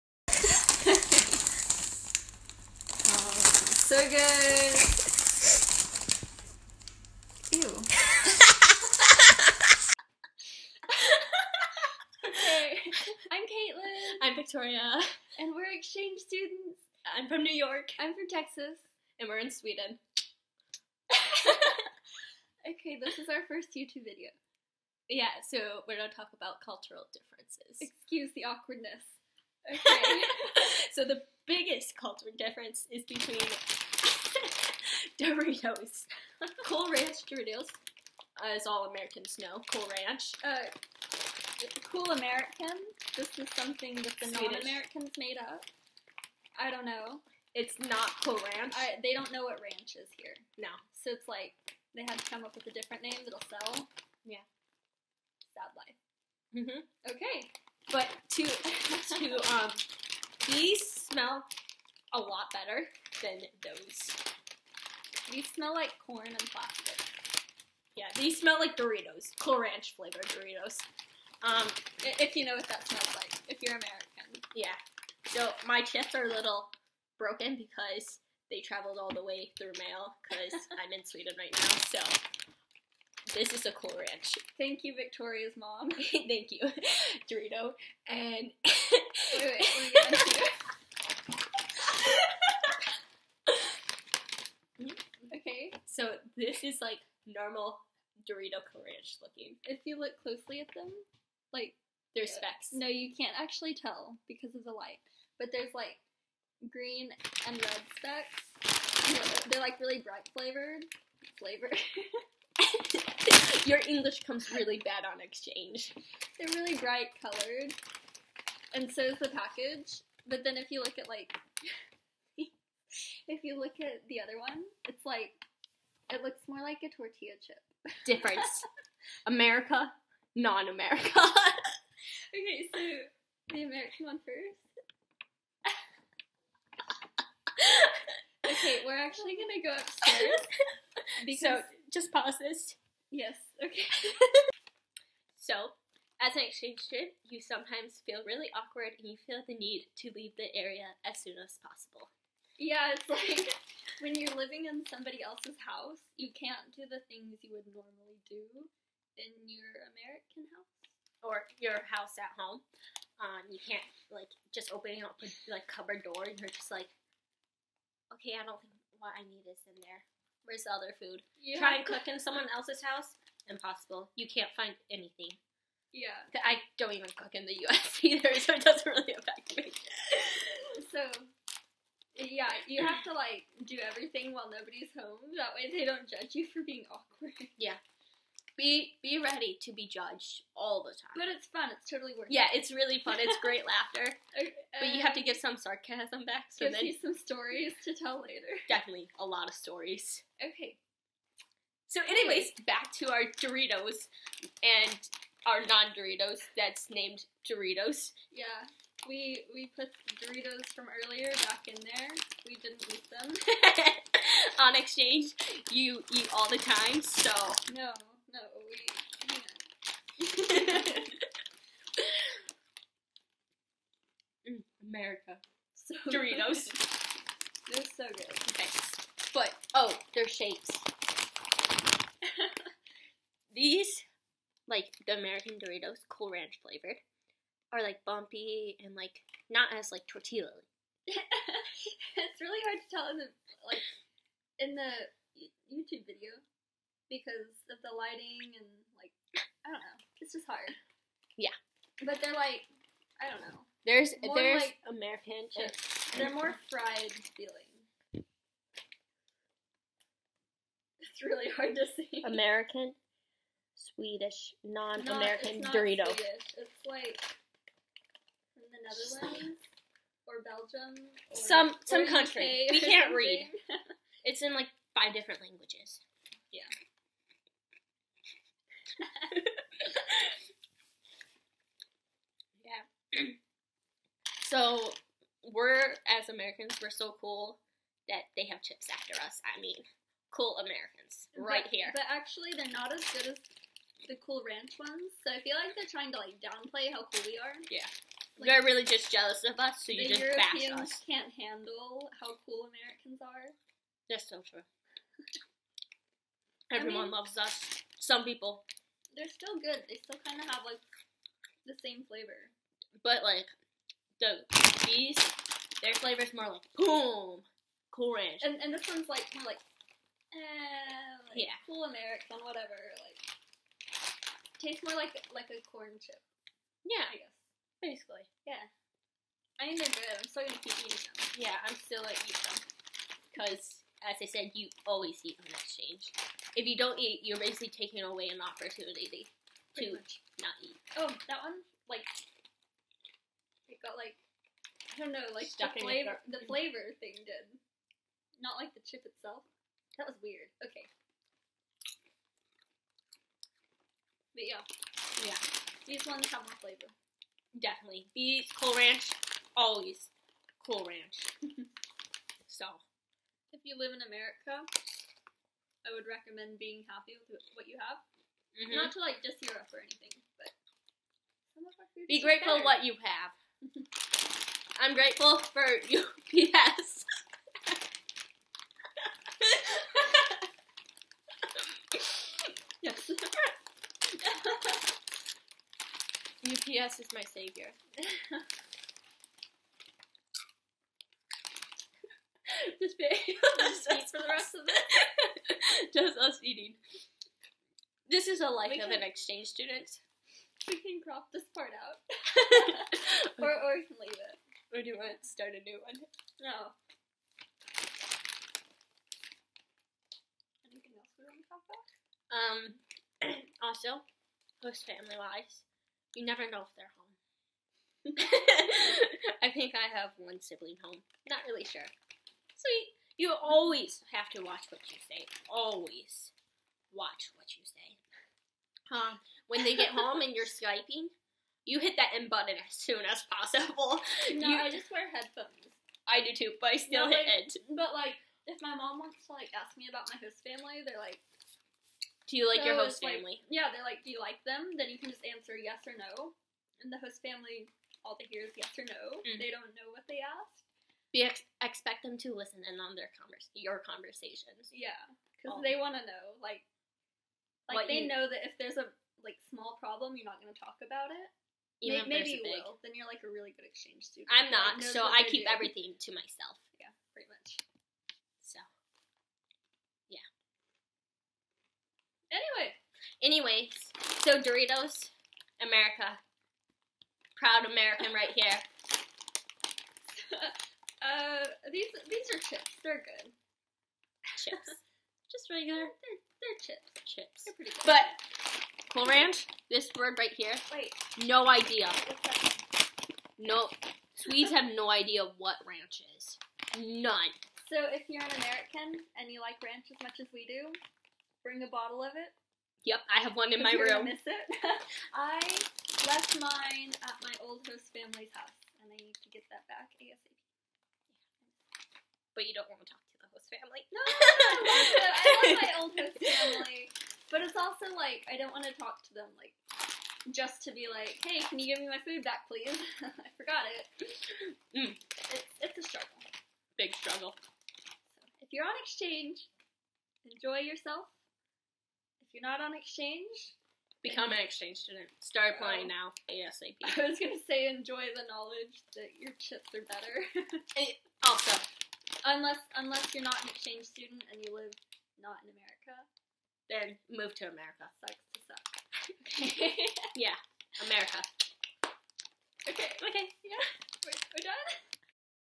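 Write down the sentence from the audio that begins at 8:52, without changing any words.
If you're not on exchange, become an exchange student.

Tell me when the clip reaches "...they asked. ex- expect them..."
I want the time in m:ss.
7:30.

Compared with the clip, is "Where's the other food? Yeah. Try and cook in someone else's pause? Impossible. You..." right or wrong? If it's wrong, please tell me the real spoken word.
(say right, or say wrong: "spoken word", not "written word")
wrong: "house", not "pause".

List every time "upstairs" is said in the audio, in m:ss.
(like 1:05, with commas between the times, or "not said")
2:19.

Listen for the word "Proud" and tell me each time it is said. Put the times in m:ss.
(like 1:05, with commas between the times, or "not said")
7:57.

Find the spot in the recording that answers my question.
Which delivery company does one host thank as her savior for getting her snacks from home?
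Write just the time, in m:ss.
6:26.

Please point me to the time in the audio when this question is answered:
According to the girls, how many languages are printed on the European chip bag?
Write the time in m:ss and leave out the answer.
4:34.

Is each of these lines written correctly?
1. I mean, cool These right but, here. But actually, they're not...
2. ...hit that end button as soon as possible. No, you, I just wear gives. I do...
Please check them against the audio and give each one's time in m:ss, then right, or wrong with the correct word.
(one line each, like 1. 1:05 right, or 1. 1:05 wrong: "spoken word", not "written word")
1. 4:49 wrong: "Americans", not "These"
2. 7:11 wrong: "headphones", not "gives".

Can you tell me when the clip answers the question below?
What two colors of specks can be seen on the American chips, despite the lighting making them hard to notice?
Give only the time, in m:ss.
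1:46.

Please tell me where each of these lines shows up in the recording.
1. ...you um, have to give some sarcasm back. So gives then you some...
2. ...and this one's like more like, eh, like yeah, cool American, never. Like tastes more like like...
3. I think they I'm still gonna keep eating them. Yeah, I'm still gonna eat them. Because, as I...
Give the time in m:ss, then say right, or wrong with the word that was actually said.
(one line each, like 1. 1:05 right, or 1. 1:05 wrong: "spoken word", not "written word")
1. 3:14 right
2. 5:18 wrong: "whatever", not "never"
3. 5:29 right.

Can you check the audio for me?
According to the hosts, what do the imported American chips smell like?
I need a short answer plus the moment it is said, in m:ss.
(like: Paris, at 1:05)
Cool Ranch flavored Doritos, at 1:08.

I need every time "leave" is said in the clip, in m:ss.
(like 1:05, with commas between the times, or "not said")
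2:30, 6:44.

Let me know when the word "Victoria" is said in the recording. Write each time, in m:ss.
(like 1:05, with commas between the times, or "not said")
0:14, 1:24.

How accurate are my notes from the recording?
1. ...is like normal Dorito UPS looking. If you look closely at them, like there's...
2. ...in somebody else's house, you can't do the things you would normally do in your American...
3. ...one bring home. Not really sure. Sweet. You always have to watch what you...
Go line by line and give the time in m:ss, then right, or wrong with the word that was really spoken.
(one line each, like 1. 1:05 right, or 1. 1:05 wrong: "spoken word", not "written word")
1. 1:36 wrong: "Courage", not "UPS"
2. 2:34 right
3. 7:00 wrong: "sibling", not "bring".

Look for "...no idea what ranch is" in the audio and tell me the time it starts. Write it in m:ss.
8:14.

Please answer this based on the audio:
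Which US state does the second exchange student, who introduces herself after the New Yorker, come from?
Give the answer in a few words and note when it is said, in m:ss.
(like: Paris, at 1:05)
Texas, at 0:17.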